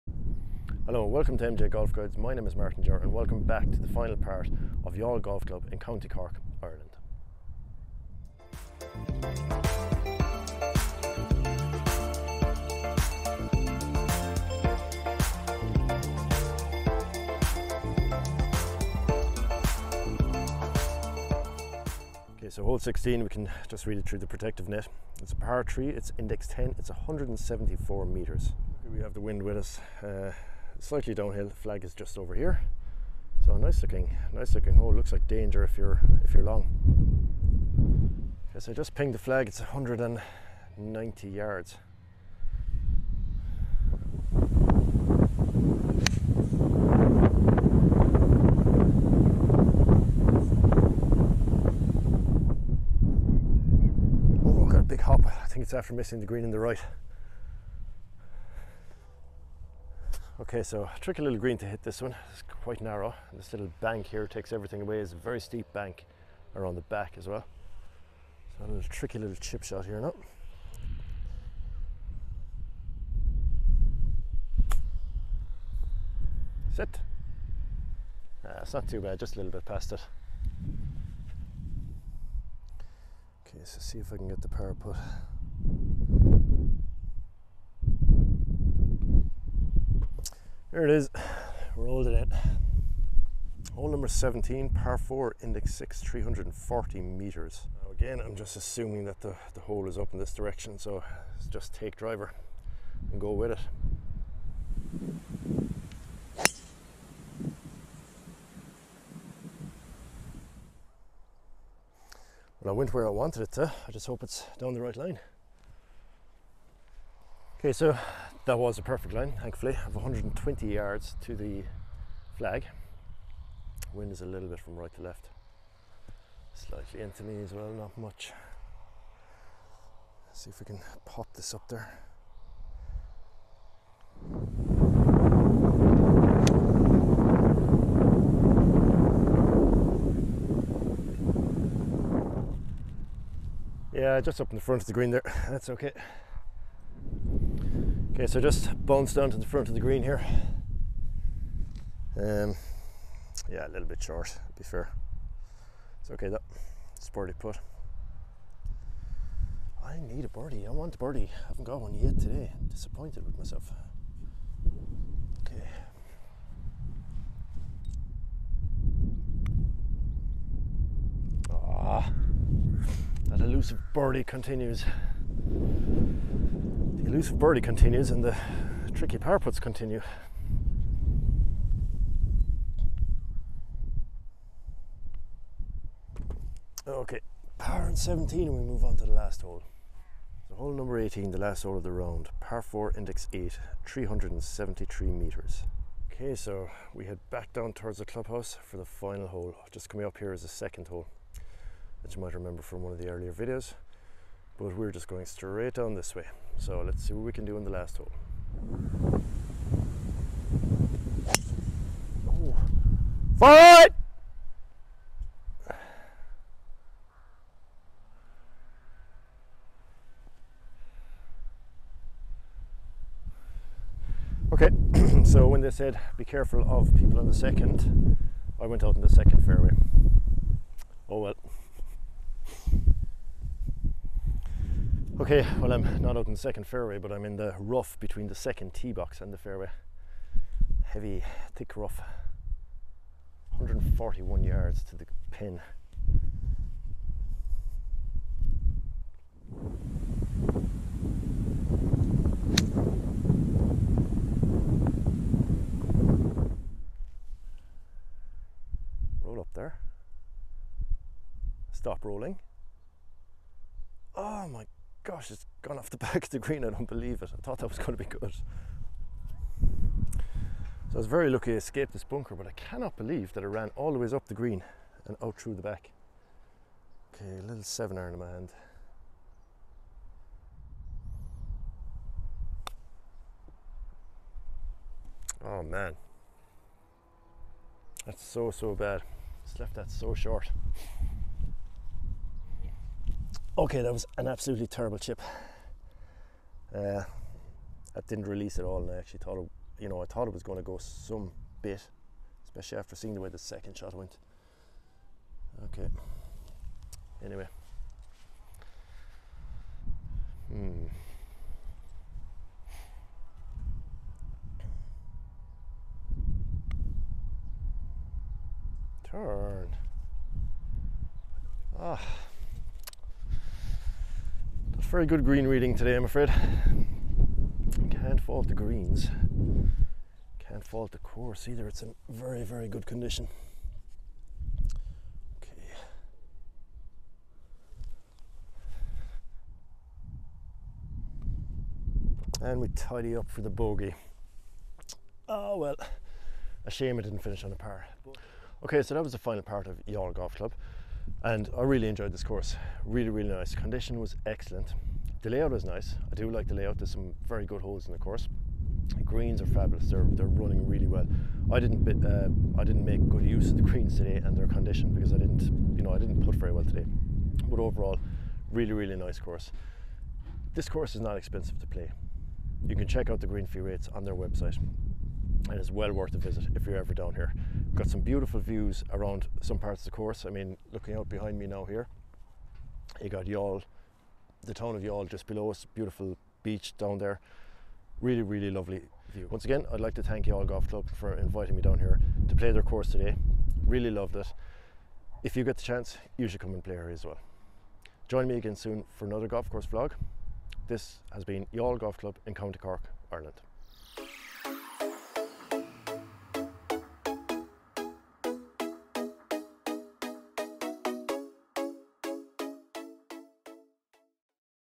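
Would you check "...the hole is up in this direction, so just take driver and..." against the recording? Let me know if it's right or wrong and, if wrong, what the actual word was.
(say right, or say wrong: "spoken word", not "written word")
right.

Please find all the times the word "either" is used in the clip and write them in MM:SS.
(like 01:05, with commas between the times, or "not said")
05:31.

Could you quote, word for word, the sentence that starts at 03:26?
So let's see what we can do in the last hole.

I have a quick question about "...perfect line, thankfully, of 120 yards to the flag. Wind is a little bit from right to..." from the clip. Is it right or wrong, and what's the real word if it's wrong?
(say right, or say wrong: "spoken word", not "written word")
right.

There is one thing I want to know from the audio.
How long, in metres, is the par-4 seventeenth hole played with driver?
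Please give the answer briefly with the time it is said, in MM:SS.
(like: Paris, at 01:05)
340 meters, at 01:36.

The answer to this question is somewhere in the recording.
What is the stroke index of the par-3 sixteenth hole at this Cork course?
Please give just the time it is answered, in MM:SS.
00:26.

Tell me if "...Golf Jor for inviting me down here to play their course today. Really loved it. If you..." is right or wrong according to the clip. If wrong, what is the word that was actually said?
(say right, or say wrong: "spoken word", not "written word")
wrong: "Club", not "Jor".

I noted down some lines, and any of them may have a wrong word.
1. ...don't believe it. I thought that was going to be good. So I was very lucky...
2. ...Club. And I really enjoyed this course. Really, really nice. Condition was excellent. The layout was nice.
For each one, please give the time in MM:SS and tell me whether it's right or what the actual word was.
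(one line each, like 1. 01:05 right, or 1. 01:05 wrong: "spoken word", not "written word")
1. 04:26 right
2. 05:50 right.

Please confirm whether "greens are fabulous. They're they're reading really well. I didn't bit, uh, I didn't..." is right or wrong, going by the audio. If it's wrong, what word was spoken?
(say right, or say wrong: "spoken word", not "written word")
wrong: "running", not "reading".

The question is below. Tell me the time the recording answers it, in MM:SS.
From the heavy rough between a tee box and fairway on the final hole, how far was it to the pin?
04:03.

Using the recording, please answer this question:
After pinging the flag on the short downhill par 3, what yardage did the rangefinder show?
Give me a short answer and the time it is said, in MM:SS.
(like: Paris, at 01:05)
190 yards, at 00:39.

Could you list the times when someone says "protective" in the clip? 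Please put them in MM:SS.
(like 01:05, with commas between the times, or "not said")
00:24.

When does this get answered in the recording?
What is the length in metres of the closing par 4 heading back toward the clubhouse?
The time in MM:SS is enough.
03:13.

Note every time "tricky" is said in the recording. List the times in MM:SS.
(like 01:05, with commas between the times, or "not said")
01:00, 01:08, 02:58.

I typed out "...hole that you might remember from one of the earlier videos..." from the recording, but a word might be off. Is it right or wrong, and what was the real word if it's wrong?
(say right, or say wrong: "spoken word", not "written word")
right.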